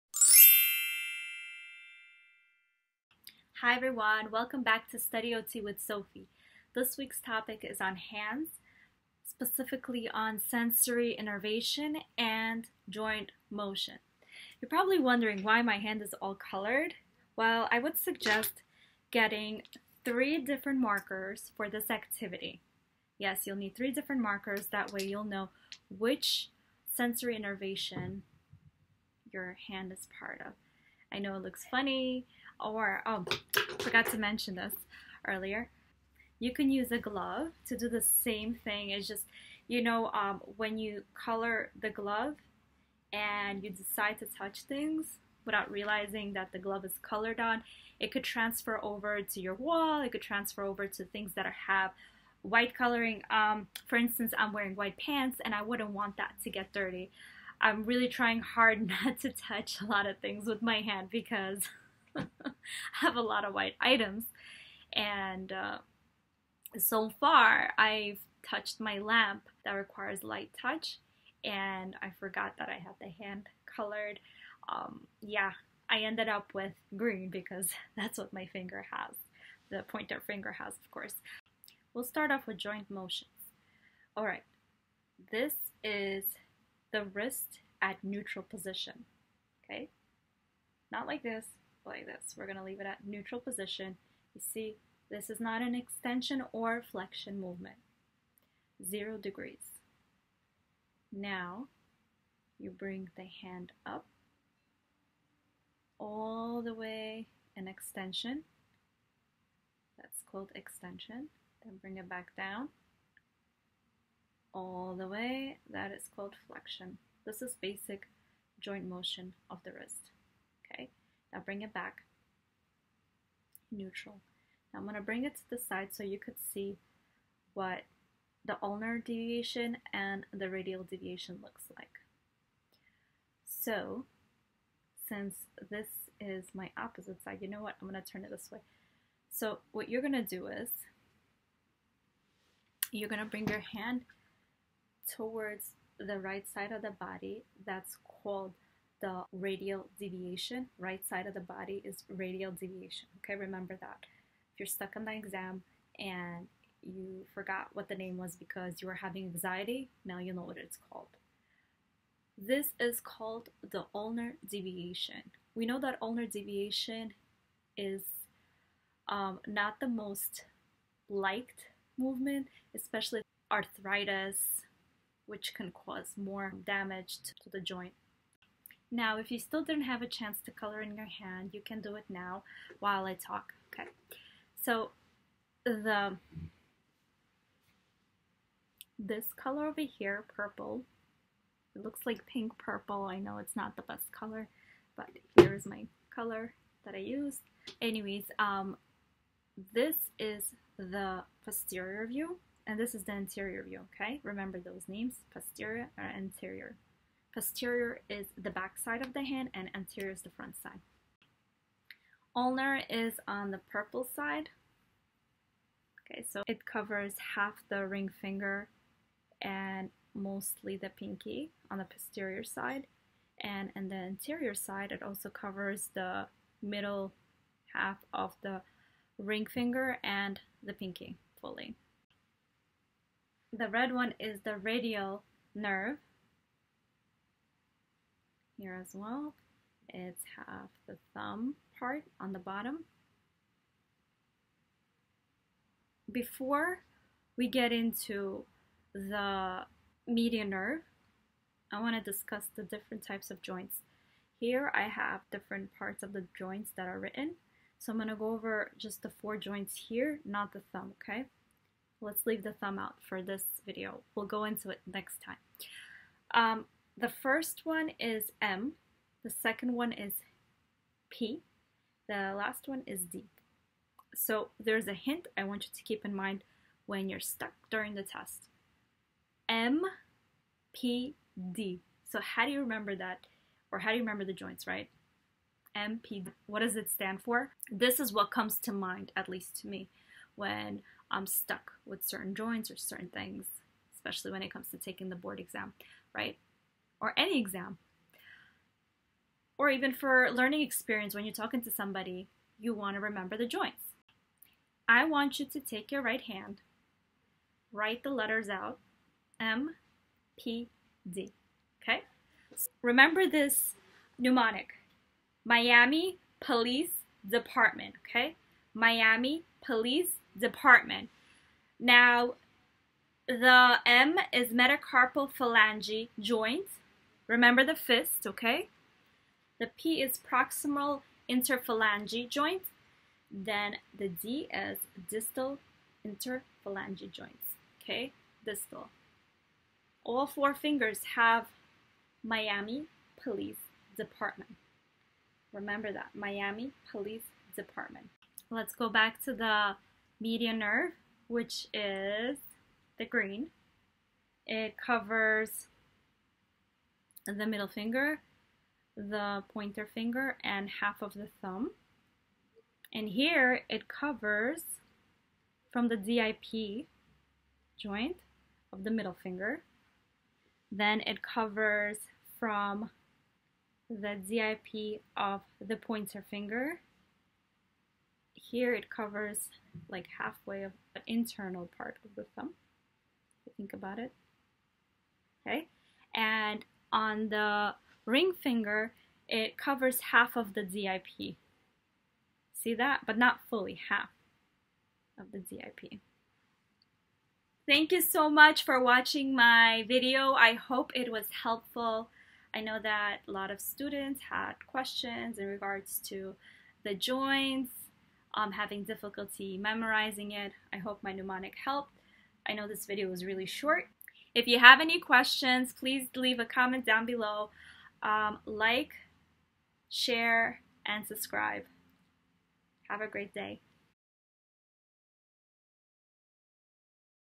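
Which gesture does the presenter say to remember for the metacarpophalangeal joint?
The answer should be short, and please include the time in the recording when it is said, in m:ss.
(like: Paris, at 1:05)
the fist, at 5:27.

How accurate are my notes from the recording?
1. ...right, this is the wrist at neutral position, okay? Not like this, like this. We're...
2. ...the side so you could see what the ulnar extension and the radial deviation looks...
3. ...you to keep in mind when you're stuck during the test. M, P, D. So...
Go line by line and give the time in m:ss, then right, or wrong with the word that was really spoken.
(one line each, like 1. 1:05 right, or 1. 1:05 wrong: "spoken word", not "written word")
1. 1:24 right
2. 2:05 wrong: "deviation", not "extension"
3. 4:35 right.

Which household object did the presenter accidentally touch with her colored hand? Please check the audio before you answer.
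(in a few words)
lamp.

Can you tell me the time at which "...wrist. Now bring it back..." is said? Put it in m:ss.
1:59.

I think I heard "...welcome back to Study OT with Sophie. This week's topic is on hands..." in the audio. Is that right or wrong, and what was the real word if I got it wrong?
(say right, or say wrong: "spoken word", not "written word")
right.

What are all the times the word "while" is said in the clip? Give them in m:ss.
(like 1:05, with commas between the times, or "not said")
3:02.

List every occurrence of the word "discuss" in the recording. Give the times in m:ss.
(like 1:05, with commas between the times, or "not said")
4:12.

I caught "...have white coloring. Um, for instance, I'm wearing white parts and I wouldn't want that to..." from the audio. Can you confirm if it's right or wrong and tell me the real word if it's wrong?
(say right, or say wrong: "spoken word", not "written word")
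wrong: "pants", not "parts".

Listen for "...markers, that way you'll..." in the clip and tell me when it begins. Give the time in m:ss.
0:24.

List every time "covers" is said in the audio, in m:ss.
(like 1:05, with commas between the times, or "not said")
3:36, 3:45, 5:54, 6:03, 6:11, 6:18, 6:29.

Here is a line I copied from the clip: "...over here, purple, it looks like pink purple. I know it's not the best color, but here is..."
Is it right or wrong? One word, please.
right.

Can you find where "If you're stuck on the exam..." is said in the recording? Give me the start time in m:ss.
2:34.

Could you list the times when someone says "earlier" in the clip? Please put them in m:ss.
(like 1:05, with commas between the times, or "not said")
0:35.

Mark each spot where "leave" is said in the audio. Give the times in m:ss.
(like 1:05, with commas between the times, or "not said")
1:32, 4:22, 6:56.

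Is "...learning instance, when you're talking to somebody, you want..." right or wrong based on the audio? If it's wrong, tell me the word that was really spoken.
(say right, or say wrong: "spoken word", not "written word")
wrong: "experience", not "instance".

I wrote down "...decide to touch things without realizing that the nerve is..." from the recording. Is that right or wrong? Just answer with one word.
wrong.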